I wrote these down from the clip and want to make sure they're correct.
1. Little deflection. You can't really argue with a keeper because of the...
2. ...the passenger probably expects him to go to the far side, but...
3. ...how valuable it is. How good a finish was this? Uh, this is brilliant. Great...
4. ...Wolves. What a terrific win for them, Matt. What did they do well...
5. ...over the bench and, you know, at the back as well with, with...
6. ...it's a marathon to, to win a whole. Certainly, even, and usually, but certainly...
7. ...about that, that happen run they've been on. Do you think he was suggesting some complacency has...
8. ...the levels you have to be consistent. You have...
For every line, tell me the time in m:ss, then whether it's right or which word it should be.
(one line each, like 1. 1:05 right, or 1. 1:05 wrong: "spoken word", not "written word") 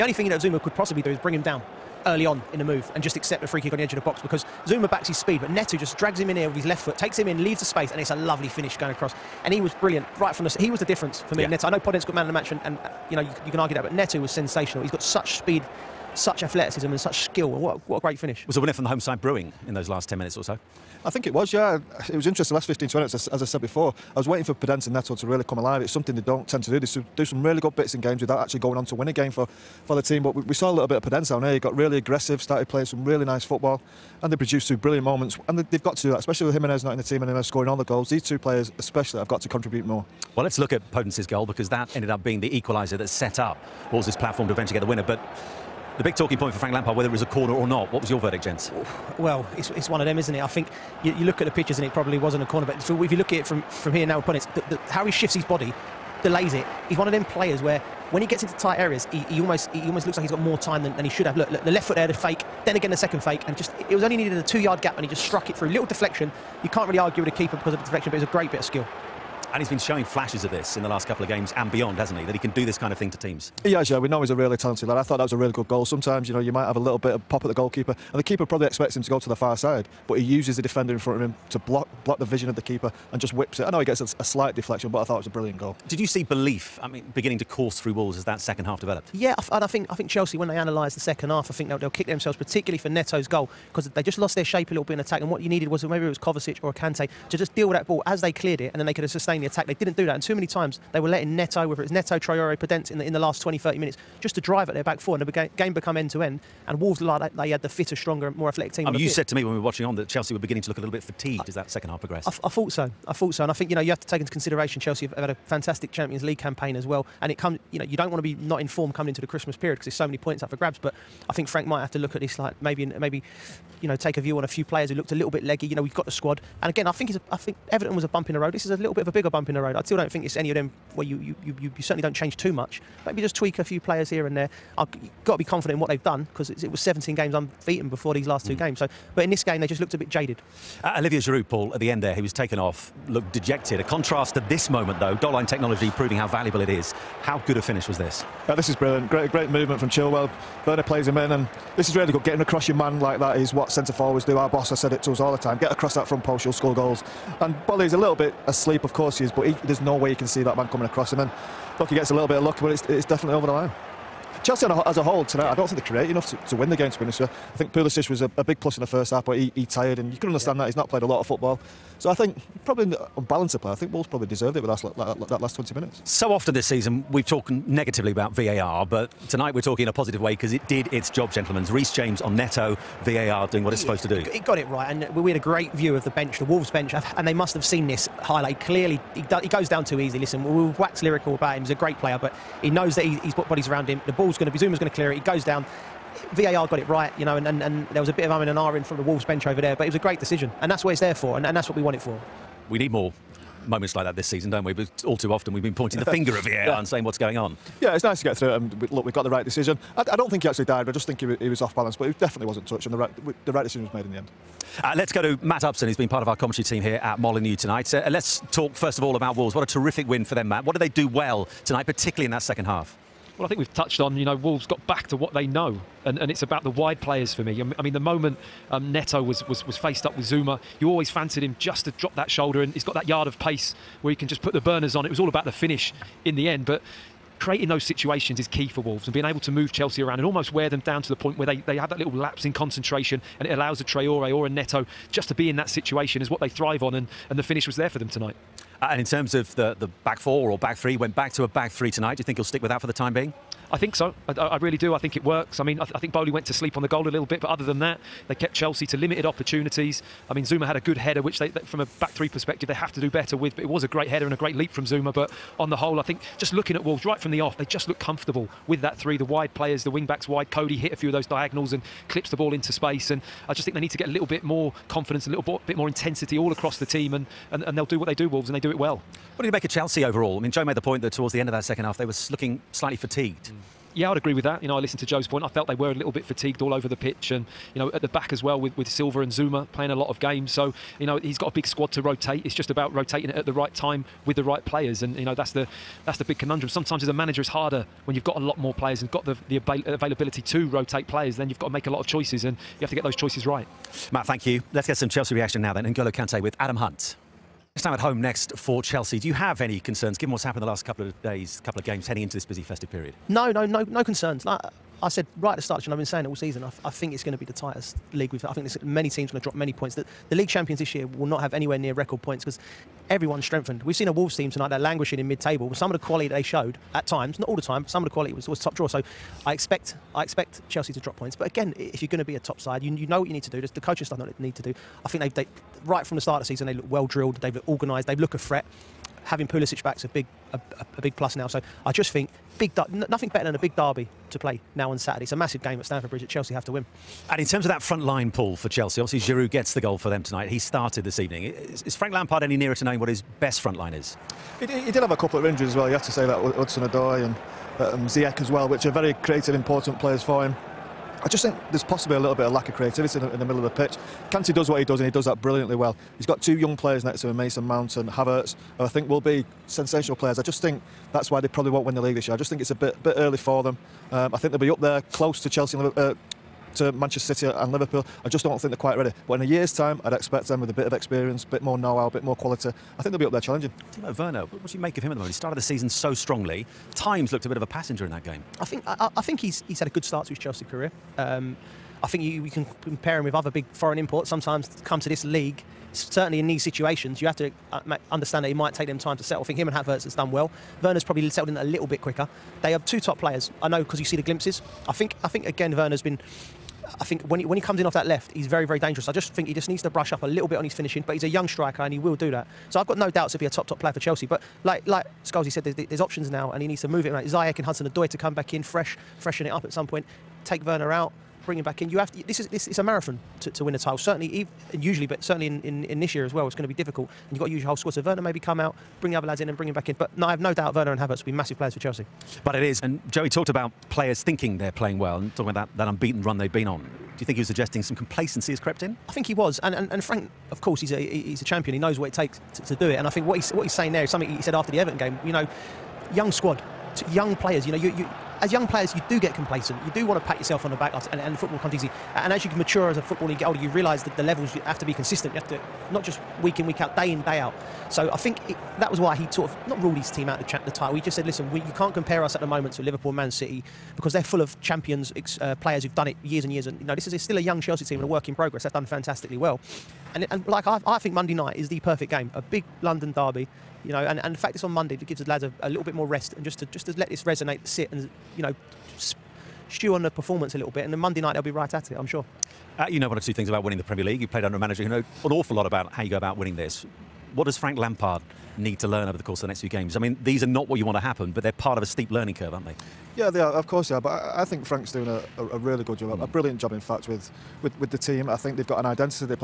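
1. 1:05 right
2. 1:18 wrong: "keeper", not "passenger"
3. 2:26 right
4. 3:39 right
5. 4:46 wrong: "pitch", not "bench"
6. 7:02 wrong: "title", not "whole"
7. 7:15 wrong: "unbeaten", not "happen"
8. 7:34 right.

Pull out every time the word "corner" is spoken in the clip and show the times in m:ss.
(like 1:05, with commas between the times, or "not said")
0:47, 0:52.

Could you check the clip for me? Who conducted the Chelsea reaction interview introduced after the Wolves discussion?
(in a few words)
Adam Hunt.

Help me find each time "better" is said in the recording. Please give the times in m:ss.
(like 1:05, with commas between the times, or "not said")
4:23, 5:43.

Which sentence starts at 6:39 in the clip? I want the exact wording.
I think him and Havertz has done well.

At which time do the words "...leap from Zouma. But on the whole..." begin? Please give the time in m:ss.
4:24.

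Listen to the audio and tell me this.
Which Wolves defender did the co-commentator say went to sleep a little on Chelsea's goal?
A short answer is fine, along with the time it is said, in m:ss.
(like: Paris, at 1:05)
Boly, at 4:16.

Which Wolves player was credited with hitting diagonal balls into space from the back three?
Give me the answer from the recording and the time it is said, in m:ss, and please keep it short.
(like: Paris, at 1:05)
Coady, at 4:30.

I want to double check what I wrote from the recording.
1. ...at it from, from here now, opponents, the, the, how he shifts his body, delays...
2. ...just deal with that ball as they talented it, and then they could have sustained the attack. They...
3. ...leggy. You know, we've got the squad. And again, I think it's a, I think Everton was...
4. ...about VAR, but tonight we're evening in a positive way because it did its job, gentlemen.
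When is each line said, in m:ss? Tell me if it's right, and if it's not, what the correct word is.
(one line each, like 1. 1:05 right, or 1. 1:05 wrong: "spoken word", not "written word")
1. 0:53 right
2. 1:37 wrong: "cleared", not "talented"
3. 2:05 right
4. 2:58 wrong: "talking", not "evening".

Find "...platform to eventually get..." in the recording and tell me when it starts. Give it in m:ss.
0:44.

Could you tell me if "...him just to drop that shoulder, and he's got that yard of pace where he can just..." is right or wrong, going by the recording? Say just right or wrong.
right.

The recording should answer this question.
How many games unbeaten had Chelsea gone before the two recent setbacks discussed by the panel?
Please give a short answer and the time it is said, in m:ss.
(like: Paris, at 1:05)
17, at 2:16.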